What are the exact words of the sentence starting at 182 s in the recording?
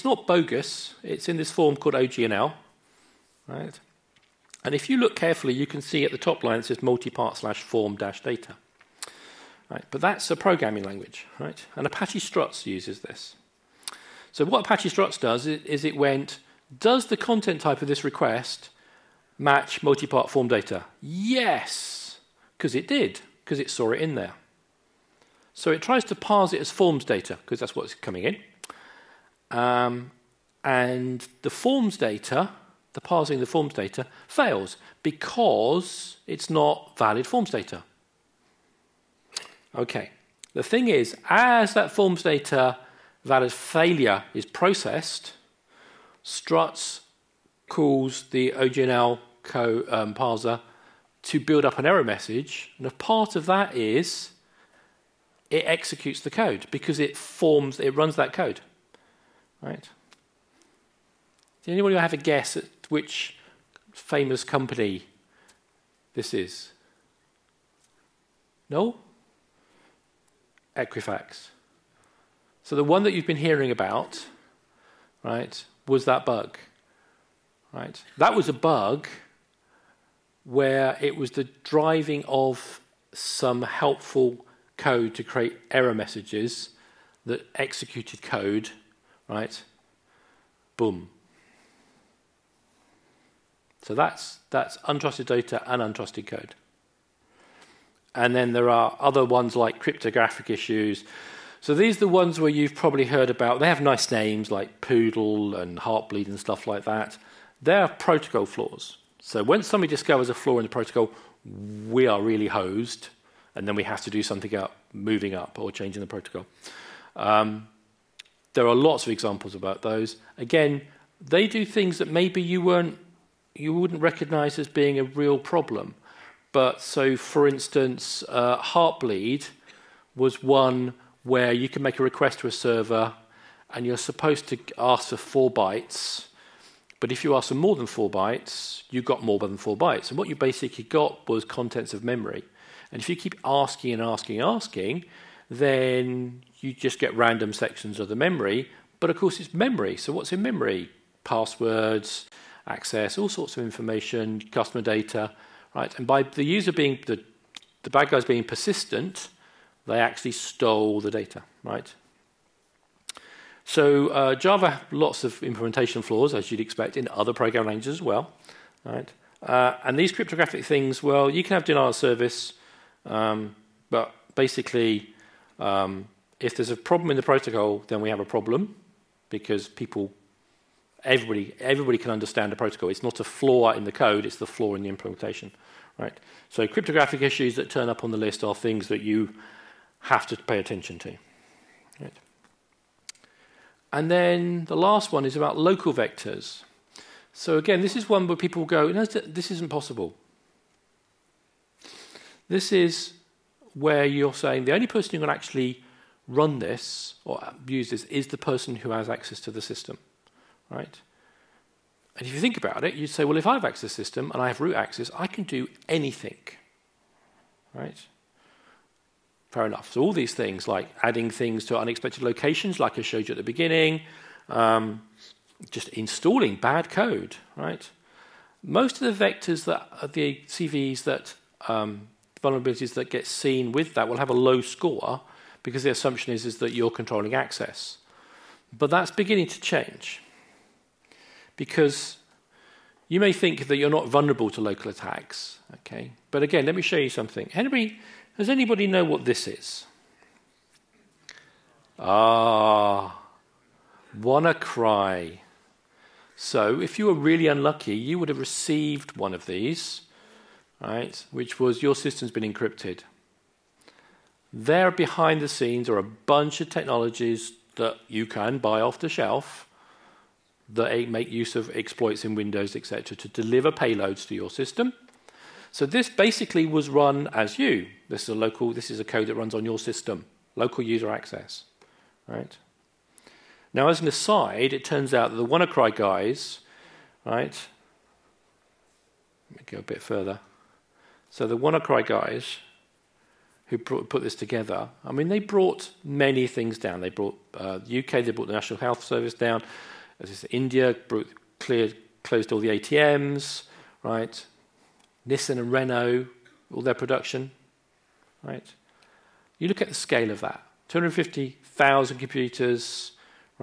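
It's not a flaw in the code; it's the flaw in the implementation, right?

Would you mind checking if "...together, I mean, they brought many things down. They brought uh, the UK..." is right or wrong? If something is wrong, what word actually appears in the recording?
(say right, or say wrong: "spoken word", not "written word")
right.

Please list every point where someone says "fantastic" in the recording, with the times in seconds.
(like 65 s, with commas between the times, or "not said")
not said.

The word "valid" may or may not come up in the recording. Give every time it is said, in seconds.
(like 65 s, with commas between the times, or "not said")
36 s, 43 s.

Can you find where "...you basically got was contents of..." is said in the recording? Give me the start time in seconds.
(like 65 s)
140 s.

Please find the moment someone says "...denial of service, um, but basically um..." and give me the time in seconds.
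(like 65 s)
171 s.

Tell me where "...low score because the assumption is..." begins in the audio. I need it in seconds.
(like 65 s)
234 s.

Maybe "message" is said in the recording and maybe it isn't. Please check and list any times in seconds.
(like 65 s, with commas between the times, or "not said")
52 s, 85 s.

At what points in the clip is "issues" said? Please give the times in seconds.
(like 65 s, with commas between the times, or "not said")
100 s, 187 s.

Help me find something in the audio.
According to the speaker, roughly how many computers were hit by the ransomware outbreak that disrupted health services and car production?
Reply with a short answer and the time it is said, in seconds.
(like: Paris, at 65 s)
250,000, at 310 s.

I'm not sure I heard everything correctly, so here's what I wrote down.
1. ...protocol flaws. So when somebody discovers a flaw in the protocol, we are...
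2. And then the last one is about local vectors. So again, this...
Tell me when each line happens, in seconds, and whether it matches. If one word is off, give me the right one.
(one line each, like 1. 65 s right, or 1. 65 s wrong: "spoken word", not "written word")
1. 107 s right
2. 193 s right.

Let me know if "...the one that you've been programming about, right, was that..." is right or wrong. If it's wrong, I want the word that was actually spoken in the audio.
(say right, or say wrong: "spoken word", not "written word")
wrong: "hearing", not "programming".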